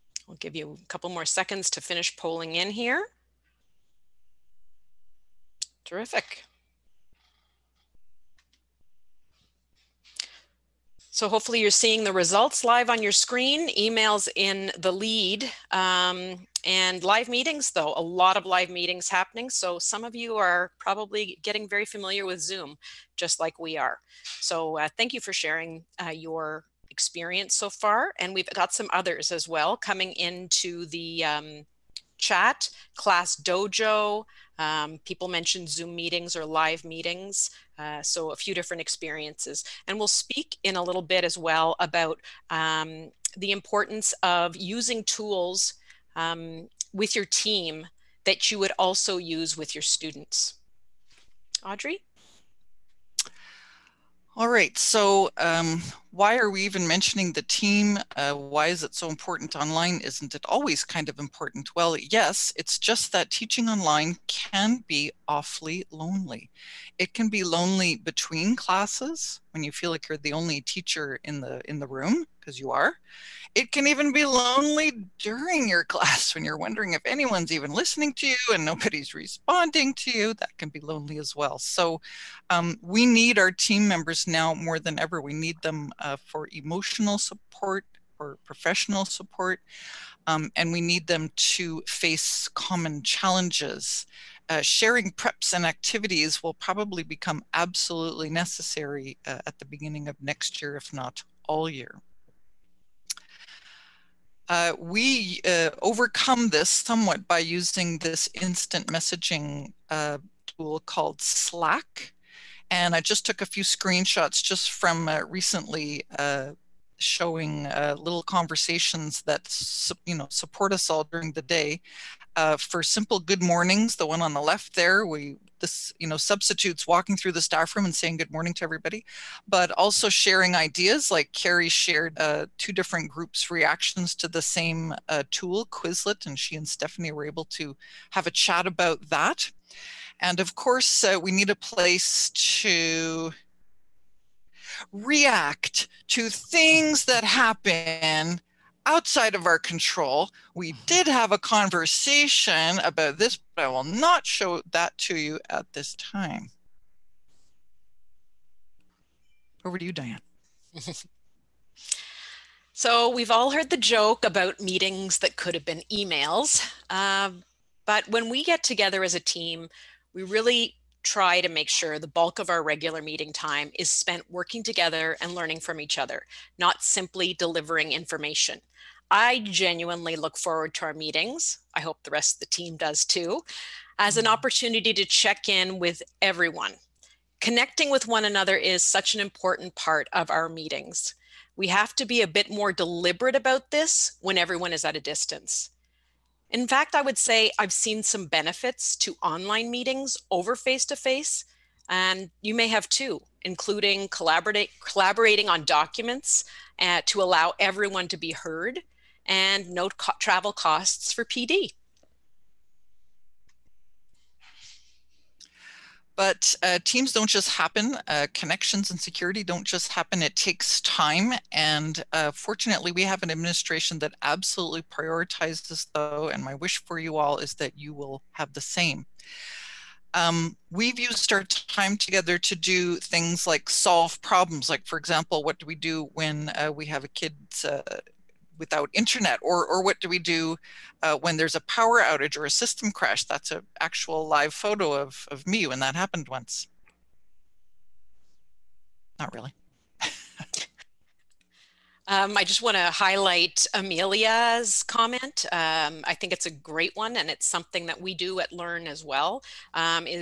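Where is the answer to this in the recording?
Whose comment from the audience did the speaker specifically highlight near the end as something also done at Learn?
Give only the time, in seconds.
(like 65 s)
253 s.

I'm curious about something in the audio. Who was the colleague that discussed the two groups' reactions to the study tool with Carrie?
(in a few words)
Stephanie.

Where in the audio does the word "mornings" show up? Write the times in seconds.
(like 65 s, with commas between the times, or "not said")
123 s, 128 s.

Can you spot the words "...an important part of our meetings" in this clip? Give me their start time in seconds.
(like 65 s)
189 s.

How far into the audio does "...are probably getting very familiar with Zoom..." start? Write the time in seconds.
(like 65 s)
20 s.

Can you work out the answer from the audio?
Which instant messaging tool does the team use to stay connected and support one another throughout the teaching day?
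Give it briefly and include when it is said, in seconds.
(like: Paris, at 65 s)
Slack, at 111 s.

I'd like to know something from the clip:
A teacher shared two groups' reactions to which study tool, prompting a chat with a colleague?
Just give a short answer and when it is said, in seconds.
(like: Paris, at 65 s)
Quizlet, at 135 s.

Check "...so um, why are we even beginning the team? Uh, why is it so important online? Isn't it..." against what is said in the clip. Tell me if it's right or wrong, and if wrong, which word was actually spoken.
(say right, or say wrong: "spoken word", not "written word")
wrong: "mentioning", not "beginning".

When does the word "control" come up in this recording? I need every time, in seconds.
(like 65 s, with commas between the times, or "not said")
149 s.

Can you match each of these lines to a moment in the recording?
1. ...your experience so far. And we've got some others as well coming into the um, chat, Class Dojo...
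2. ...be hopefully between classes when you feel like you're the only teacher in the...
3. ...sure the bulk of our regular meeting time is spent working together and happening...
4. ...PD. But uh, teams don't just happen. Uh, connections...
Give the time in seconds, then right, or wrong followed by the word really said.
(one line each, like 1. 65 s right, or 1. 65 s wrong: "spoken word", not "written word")
1. 26 s right
2. 67 s wrong: "lonely", not "hopefully"
3. 171 s wrong: "learning", not "happening"
4. 211 s right.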